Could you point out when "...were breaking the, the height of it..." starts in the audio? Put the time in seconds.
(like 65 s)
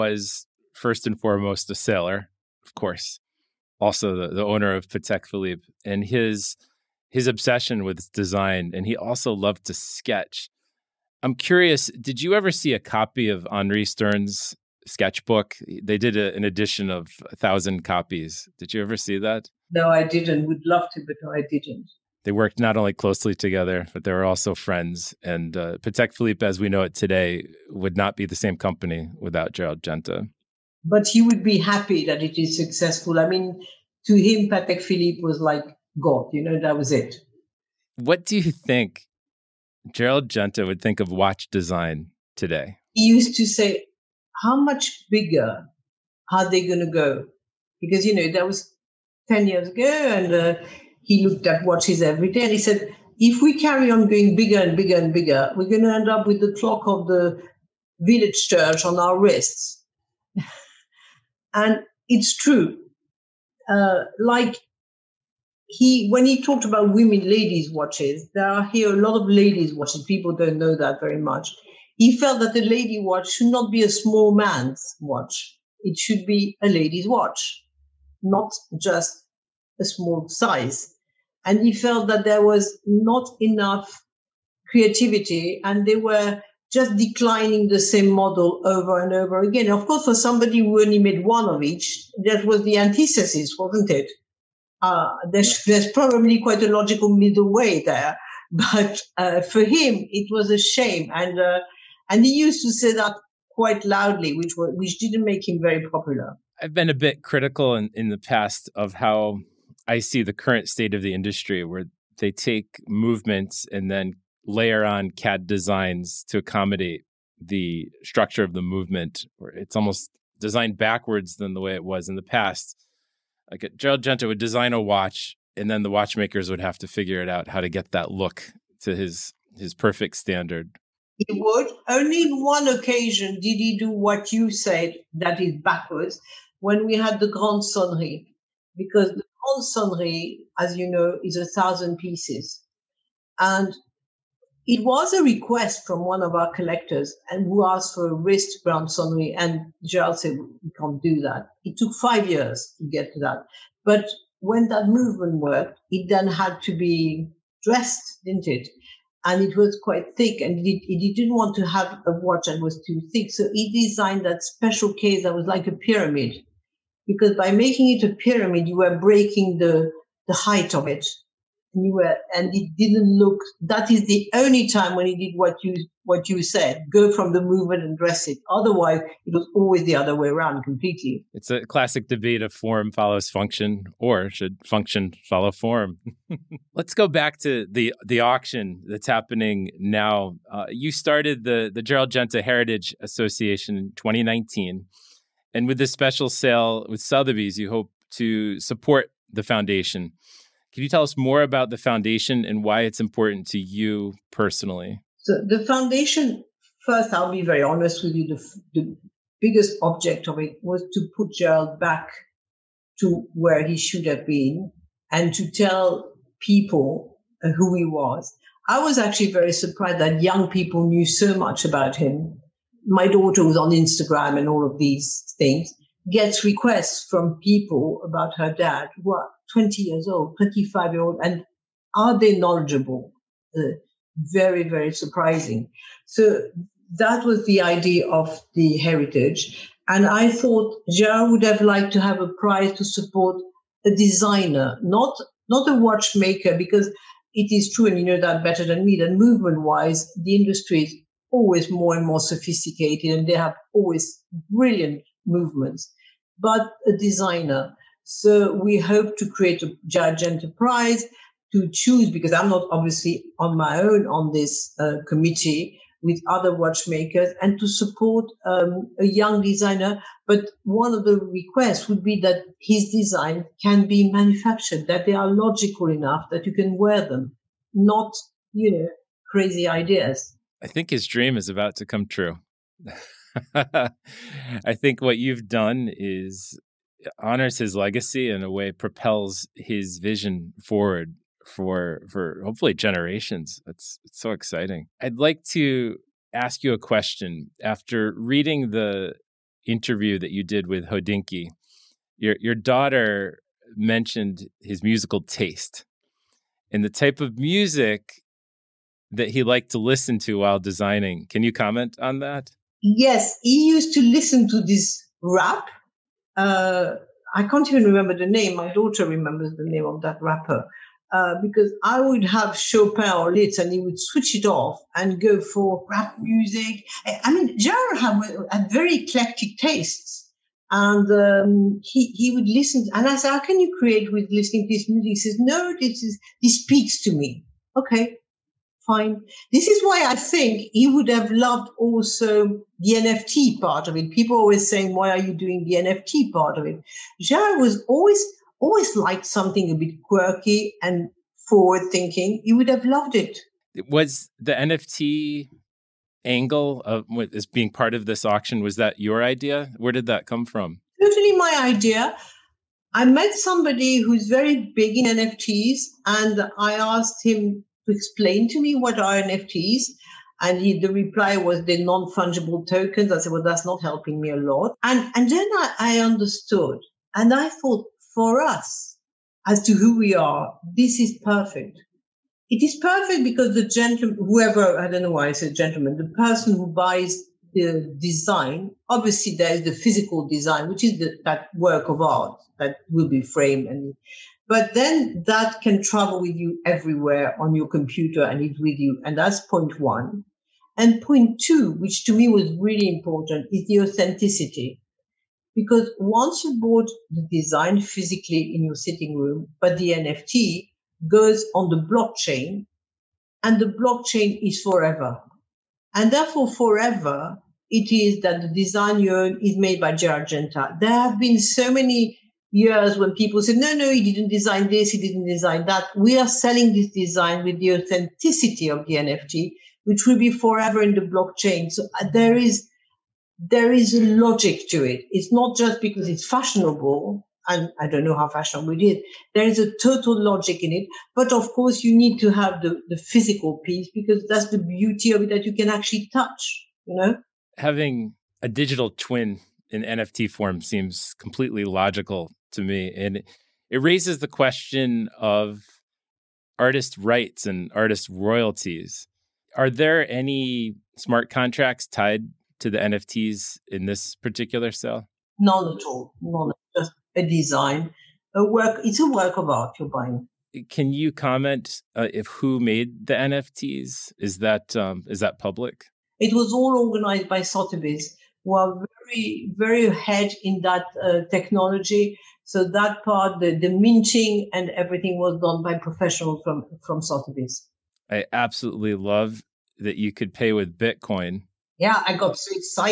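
168 s.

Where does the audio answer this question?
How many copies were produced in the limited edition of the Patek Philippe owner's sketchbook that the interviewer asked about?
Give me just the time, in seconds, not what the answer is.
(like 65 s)
17 s.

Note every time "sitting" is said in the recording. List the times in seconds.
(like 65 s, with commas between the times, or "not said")
408 s.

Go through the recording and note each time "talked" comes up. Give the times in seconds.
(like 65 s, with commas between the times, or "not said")
66 s.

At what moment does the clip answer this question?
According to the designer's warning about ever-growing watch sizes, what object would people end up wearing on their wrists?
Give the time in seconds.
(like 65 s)
56 s.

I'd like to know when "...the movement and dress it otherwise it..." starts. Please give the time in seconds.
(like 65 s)
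177 s.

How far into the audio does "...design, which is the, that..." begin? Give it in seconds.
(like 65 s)
390 s.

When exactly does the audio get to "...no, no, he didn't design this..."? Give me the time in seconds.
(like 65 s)
423 s.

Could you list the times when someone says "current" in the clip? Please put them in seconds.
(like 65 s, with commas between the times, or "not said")
110 s.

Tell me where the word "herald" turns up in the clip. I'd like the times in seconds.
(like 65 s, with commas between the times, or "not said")
not said.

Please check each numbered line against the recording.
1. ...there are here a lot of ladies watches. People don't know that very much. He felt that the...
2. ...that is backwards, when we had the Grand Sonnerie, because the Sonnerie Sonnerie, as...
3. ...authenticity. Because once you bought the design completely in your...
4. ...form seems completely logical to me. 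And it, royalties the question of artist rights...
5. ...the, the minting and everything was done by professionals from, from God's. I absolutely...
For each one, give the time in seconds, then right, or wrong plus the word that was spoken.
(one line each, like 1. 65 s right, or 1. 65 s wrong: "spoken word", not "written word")
1. 68 s right
2. 135 s wrong: "Grand", not "Sonnerie"
3. 403 s wrong: "physically", not "completely"
4. 450 s wrong: "raises", not "royalties"
5. 483 s wrong: "Sotheby", not "God".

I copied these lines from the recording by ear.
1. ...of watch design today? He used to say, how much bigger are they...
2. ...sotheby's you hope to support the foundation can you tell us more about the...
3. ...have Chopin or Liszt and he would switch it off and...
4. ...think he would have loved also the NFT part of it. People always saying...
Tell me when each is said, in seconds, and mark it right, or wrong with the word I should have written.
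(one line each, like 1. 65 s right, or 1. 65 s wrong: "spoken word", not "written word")
1. 40 s right
2. 196 s right
3. 322 s right
4. 340 s right.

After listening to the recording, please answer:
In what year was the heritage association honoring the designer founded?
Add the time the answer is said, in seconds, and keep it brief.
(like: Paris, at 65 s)
2019, at 193 s.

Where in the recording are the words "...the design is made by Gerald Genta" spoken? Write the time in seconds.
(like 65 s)
418 s.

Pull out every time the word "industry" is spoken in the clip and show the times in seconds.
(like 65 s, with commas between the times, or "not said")
111 s, 250 s.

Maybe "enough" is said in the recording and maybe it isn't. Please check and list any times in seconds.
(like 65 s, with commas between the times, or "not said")
83 s, 275 s.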